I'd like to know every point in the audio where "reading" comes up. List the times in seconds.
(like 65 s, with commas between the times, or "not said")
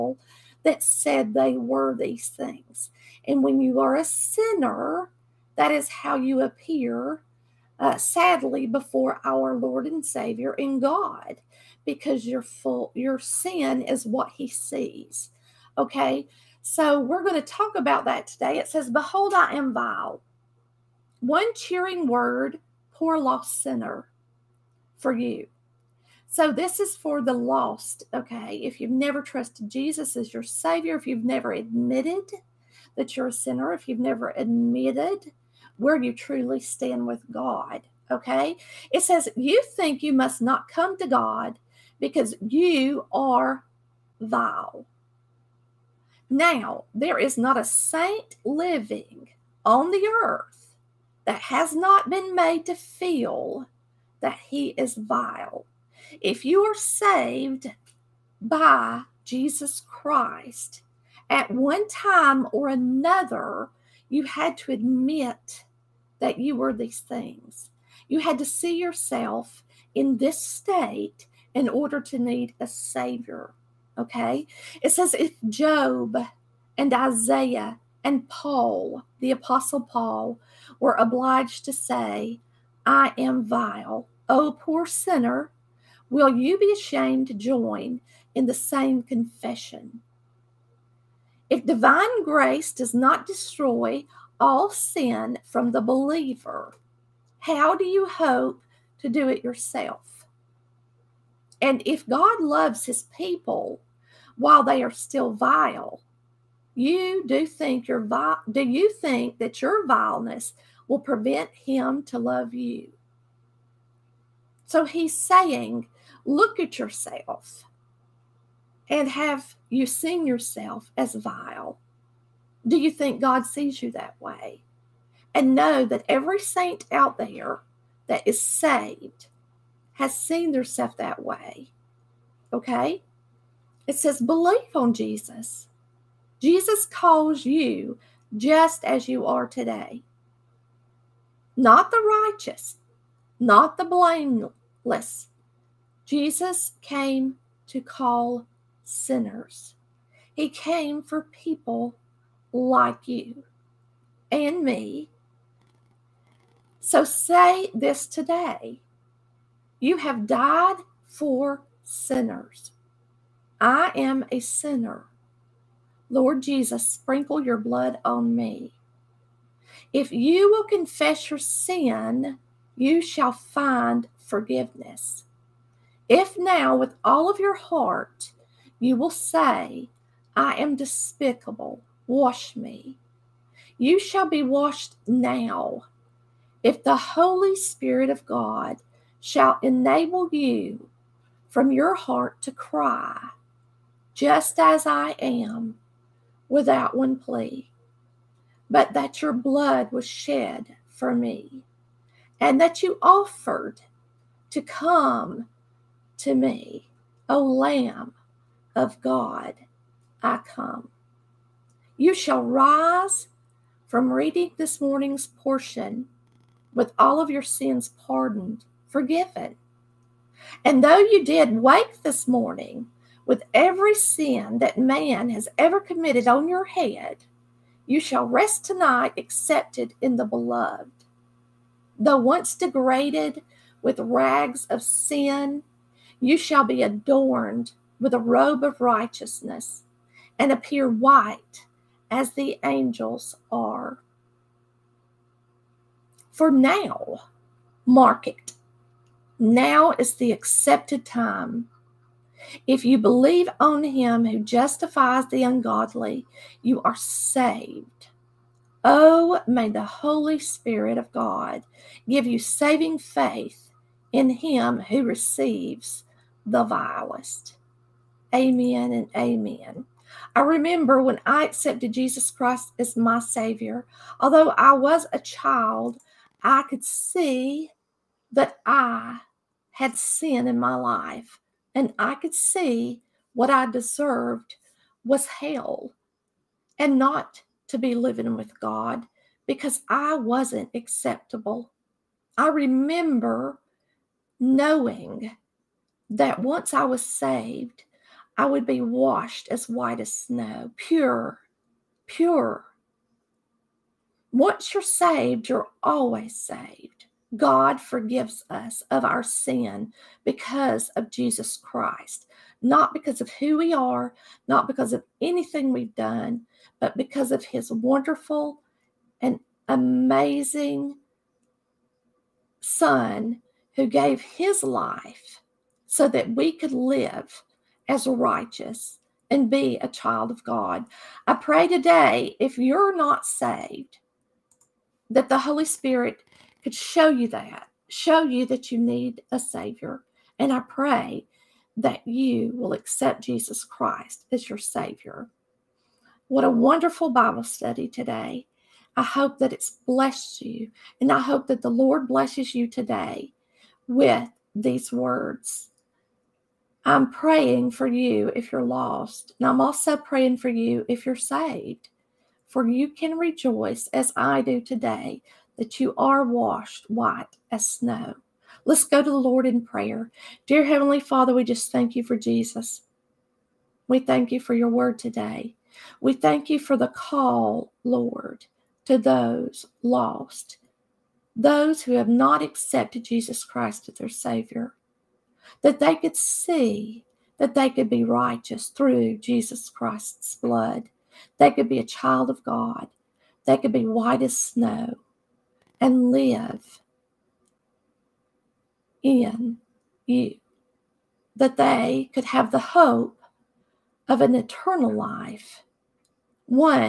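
214 s.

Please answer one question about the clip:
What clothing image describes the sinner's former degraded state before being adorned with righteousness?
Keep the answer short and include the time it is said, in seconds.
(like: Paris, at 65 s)
rags of sin, at 233 s.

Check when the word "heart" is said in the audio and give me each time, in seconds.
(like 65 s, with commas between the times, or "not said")
177 s, 191 s.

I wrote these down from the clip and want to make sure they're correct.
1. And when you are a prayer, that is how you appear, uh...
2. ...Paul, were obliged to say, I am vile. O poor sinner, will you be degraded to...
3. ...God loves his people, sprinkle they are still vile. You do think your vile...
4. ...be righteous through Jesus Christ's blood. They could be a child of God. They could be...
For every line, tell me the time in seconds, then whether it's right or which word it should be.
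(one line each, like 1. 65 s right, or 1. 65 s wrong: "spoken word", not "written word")
1. 3 s wrong: "sinner", not "prayer"
2. 79 s wrong: "ashamed", not "degraded"
3. 102 s wrong: "while", not "sprinkle"
4. 387 s right.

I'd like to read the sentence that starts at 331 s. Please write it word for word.
I pray today, if you're not saved, that the Holy Spirit could show you that, show you that you need a Savior.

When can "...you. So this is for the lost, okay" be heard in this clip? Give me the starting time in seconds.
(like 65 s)
25 s.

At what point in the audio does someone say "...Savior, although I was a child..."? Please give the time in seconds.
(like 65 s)
273 s.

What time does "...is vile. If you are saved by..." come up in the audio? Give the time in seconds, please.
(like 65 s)
54 s.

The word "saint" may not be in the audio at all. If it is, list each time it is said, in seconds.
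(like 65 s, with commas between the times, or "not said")
47 s, 126 s.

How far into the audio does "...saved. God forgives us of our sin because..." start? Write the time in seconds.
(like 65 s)
306 s.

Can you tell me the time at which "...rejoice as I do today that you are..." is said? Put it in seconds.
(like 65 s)
363 s.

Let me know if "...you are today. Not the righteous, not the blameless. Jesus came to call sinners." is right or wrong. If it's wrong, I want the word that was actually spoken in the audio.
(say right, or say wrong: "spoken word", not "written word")
right.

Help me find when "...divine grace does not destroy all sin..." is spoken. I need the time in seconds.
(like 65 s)
91 s.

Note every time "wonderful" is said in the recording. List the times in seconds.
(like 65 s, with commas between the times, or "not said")
317 s, 346 s.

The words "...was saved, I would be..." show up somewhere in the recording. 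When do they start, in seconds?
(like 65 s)
296 s.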